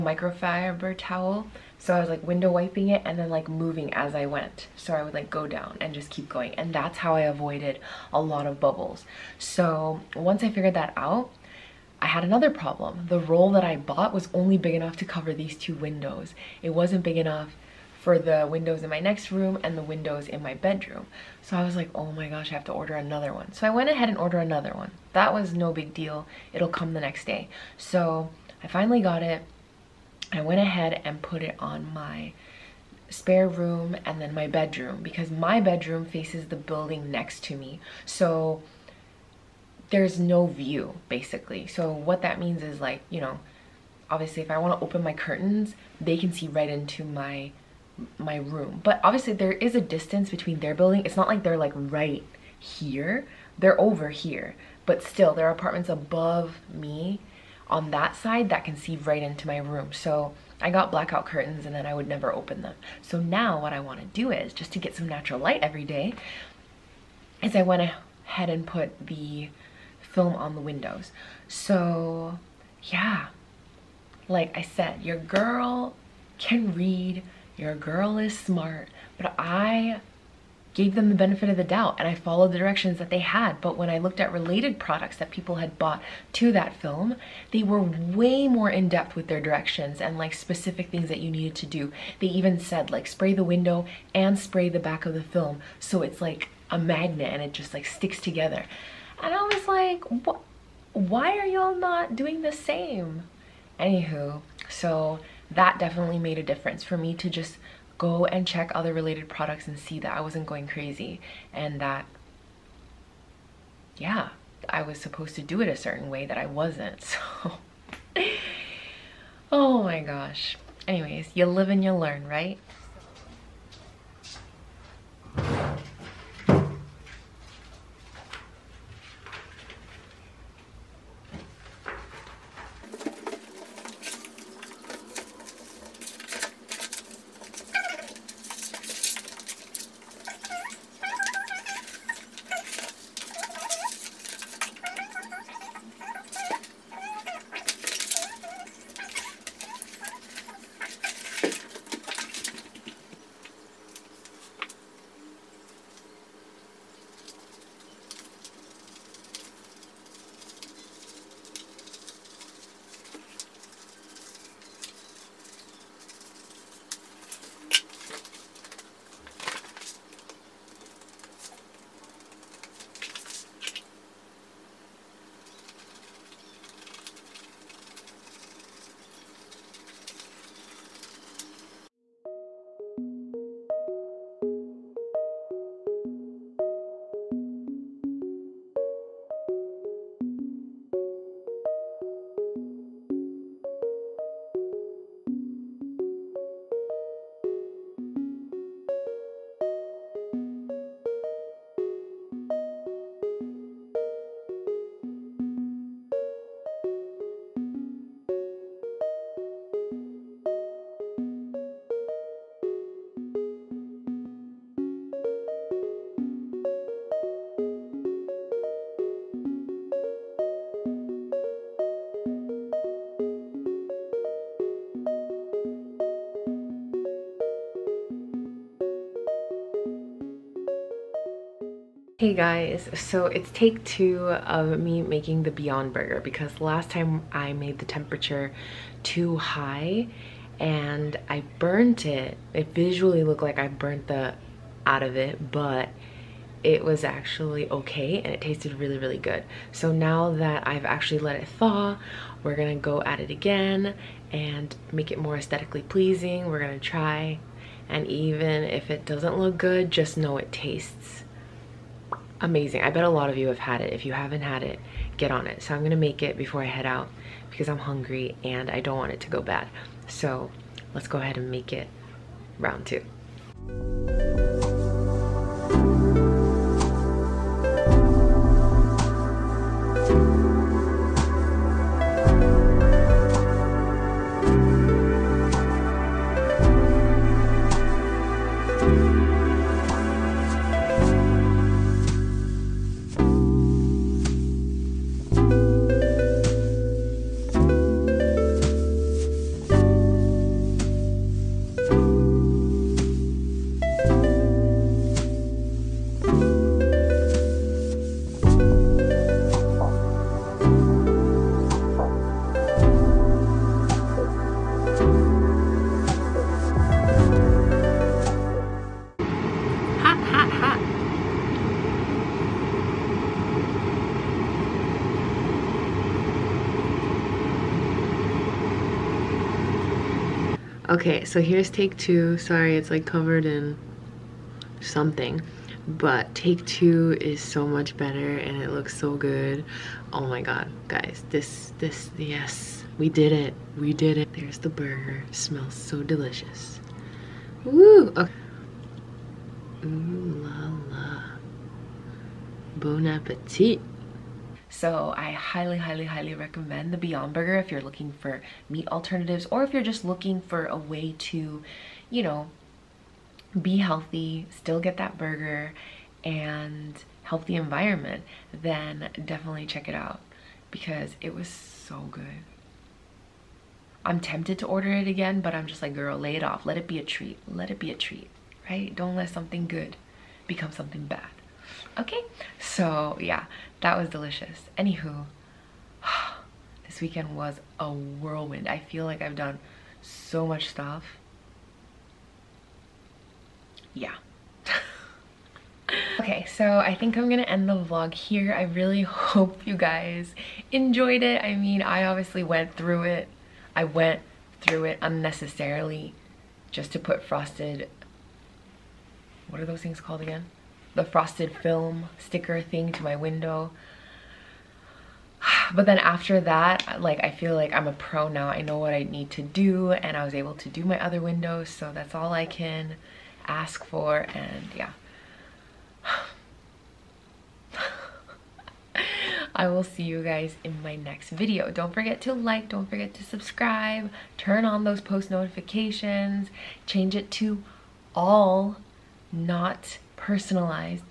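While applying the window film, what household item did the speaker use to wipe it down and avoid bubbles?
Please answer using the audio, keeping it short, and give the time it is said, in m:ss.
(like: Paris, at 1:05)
towel, at 0:00.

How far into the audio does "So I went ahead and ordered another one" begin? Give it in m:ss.
0:23.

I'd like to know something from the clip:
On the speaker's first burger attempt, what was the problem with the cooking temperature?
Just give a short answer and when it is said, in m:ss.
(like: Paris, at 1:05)
too high, at 3:59.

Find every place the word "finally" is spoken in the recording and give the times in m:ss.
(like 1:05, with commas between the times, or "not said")
0:28.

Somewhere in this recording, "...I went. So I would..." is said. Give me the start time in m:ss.
0:04.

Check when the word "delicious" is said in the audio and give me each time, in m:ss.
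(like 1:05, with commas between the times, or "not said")
5:46, 6:24.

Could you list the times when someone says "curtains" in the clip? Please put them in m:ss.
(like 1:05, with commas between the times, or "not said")
0:45, 1:01.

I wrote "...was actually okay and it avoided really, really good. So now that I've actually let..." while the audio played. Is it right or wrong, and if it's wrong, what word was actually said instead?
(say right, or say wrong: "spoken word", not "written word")
wrong: "tasted", not "avoided".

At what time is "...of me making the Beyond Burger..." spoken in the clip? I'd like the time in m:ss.
3:54.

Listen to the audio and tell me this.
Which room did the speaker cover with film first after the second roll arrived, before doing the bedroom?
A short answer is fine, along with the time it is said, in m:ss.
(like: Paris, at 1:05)
spare room, at 0:33.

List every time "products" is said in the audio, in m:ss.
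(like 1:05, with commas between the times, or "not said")
1:24, 1:49.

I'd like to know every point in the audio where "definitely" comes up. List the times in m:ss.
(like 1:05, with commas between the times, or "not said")
1:45, 6:09.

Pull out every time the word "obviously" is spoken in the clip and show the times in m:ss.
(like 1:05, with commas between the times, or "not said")
0:44, 0:49, 6:42.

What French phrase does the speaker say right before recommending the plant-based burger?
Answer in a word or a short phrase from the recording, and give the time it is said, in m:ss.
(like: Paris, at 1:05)
Bon appetit, at 5:52.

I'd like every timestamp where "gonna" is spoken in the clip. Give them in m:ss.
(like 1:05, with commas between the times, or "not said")
4:12, 4:16, 4:25, 6:37.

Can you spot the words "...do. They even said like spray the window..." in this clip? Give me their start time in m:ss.
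1:31.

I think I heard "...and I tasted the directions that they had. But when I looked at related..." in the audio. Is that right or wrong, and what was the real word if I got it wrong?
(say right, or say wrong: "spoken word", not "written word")
wrong: "followed", not "tasted".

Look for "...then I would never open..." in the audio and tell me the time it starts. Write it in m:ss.
1:01.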